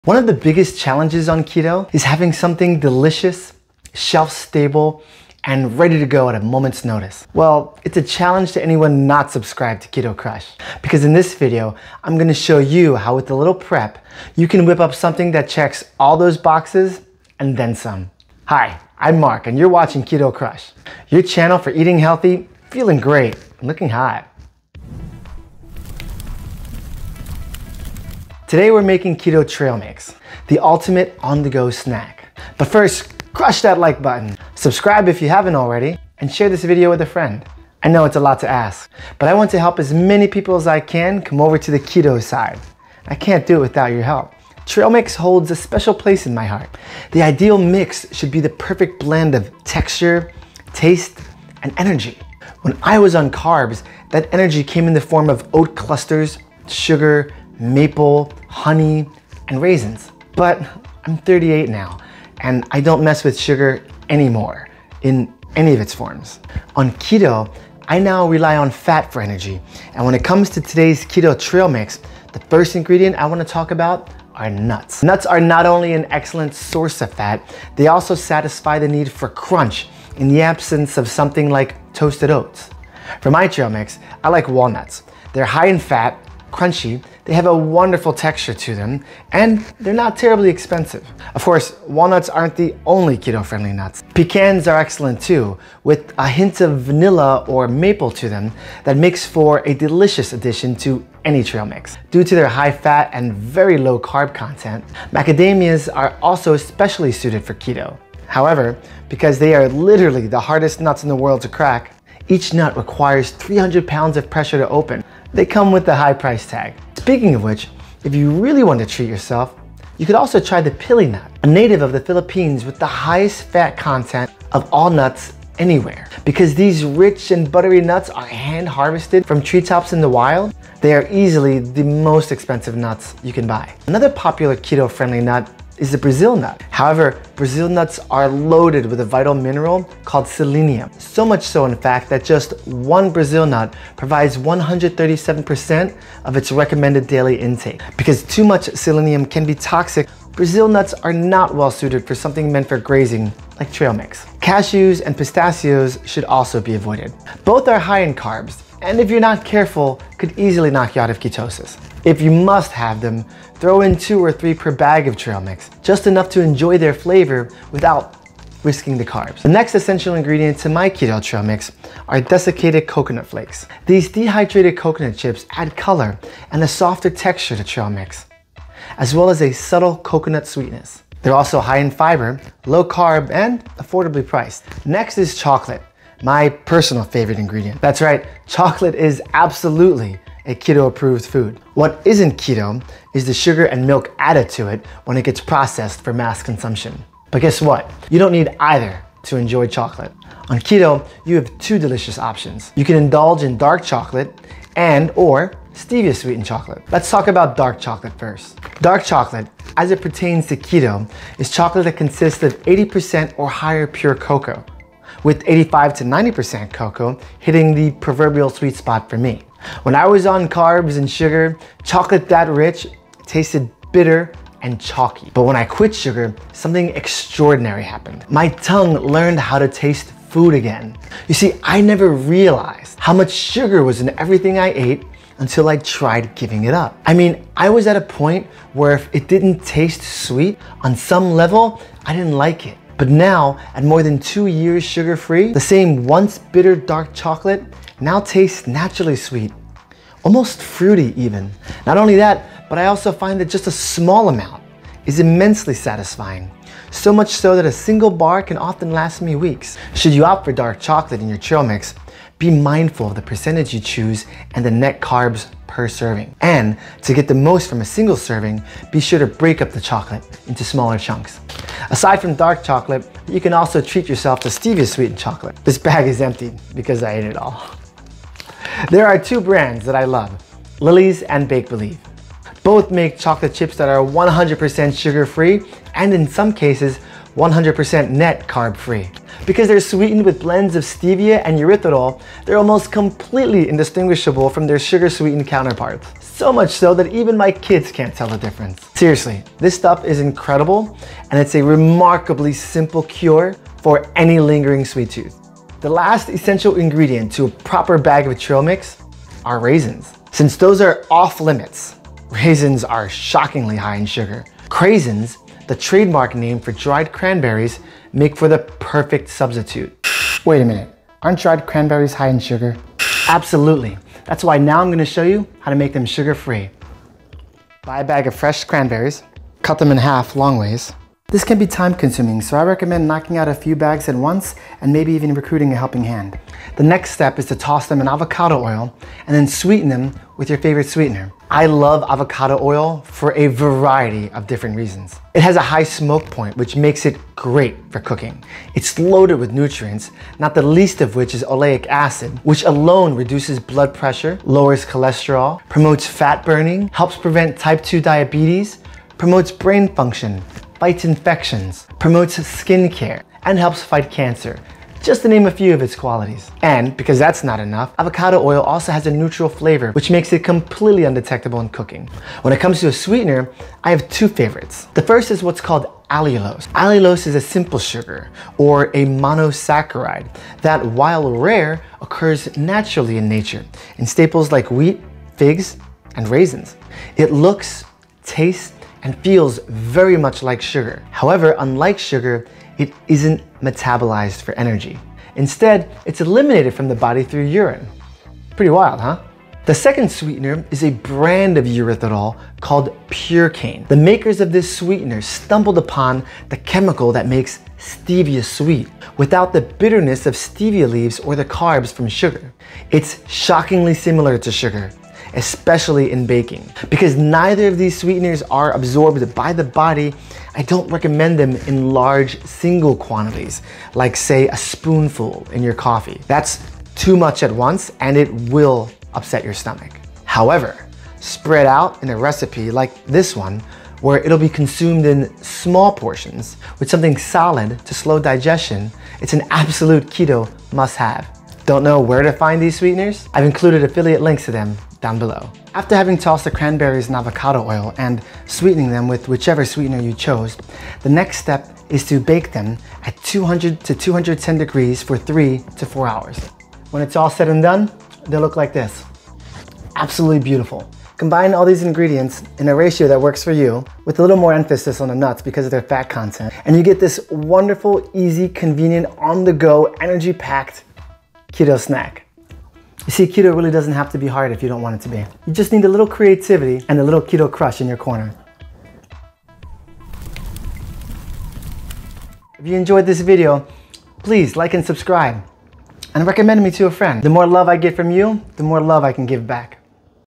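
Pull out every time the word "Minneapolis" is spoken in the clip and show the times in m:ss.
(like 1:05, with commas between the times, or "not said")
not said.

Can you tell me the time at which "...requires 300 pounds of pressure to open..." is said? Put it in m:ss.
1:52.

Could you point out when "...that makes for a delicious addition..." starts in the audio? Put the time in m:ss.
1:38.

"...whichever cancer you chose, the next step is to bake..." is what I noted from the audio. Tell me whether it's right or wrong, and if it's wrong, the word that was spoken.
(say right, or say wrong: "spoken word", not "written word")
wrong: "sweetener", not "cancer".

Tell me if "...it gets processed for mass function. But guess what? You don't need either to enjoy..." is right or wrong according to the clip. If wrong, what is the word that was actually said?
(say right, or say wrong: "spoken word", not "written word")
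wrong: "consumption", not "function".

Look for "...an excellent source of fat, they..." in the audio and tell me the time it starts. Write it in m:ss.
1:15.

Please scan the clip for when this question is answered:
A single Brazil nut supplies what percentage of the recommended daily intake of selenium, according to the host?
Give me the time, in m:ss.
2:24.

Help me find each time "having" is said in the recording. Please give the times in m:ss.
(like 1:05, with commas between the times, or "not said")
0:02, 7:25.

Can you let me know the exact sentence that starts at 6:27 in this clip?
It looks, tastes, and feels very much like sugar.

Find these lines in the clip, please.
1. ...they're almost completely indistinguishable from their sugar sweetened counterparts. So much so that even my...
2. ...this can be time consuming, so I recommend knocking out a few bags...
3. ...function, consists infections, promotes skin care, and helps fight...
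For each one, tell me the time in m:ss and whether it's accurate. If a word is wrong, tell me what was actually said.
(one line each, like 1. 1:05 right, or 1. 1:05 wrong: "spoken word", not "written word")
1. 4:52 right
2. 5:31 right
3. 5:59 wrong: "fights", not "consists".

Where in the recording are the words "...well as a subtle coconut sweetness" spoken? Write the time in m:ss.
2:59.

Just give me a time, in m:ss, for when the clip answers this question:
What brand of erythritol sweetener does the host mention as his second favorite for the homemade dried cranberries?
6:43.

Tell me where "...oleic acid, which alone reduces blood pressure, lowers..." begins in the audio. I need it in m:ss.
5:51.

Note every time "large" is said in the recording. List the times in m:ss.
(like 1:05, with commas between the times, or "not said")
7:01.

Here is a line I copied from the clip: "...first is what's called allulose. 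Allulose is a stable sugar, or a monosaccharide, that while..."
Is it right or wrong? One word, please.
wrong.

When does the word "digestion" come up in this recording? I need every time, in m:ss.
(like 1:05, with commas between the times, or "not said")
7:18.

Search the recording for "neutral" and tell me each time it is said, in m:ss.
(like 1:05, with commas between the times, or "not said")
6:09.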